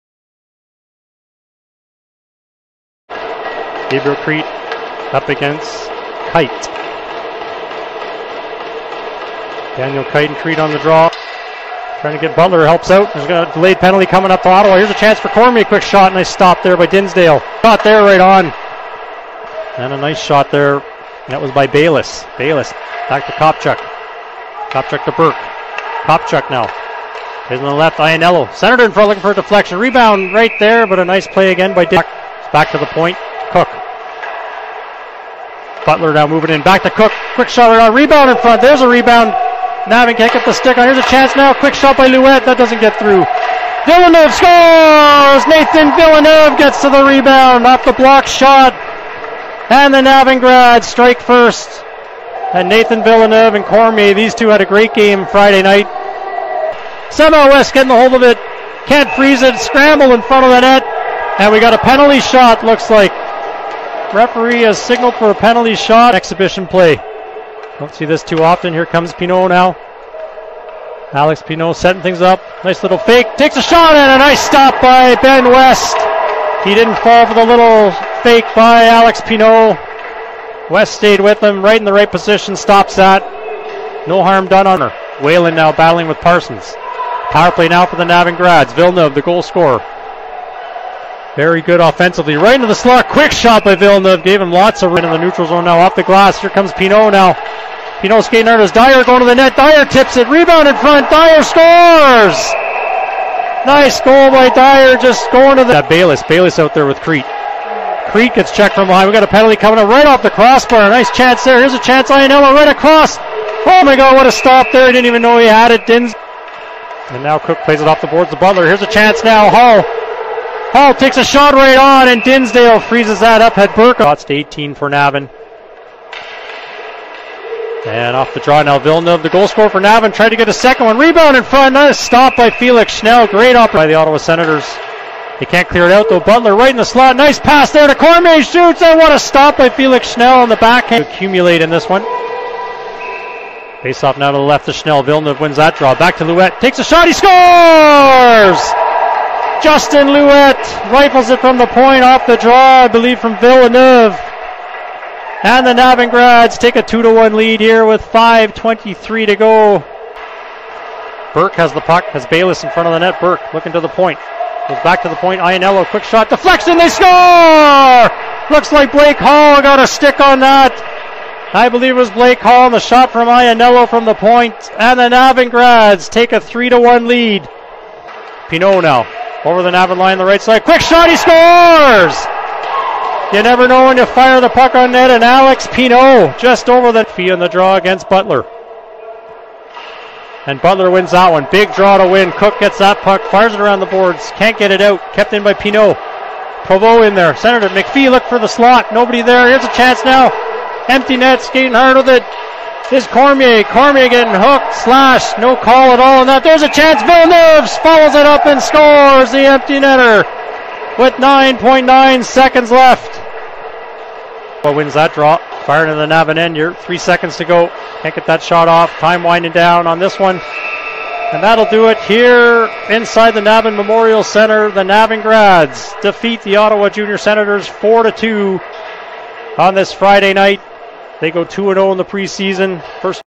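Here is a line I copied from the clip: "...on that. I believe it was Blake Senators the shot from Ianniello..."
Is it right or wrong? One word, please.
wrong.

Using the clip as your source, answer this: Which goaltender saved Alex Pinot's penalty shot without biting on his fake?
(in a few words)
Ben West.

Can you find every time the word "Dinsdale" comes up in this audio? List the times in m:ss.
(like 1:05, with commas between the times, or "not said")
0:16, 2:02.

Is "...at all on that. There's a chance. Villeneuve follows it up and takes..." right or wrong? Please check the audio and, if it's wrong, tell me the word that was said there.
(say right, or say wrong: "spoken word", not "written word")
wrong: "scores", not "takes".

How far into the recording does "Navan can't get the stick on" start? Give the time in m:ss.
0:39.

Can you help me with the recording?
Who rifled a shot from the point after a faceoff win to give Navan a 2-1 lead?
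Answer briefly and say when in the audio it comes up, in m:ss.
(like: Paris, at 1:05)
Justin Louette, at 2:29.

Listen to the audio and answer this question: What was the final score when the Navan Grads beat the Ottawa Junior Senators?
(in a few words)
4 to 2.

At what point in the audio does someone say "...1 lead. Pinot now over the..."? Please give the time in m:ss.
2:56.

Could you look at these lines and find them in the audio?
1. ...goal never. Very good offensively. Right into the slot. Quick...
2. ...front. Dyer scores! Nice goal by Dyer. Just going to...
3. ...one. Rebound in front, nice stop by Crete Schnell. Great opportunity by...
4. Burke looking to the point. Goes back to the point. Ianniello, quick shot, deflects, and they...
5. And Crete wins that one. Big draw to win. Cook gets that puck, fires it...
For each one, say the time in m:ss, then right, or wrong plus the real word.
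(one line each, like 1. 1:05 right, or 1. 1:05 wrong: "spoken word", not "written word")
1. 1:29 wrong: "scorer", not "never"
2. 1:40 right
3. 2:10 wrong: "Felix", not "Crete"
4. 2:43 right
5. 3:10 wrong: "Butler", not "Crete".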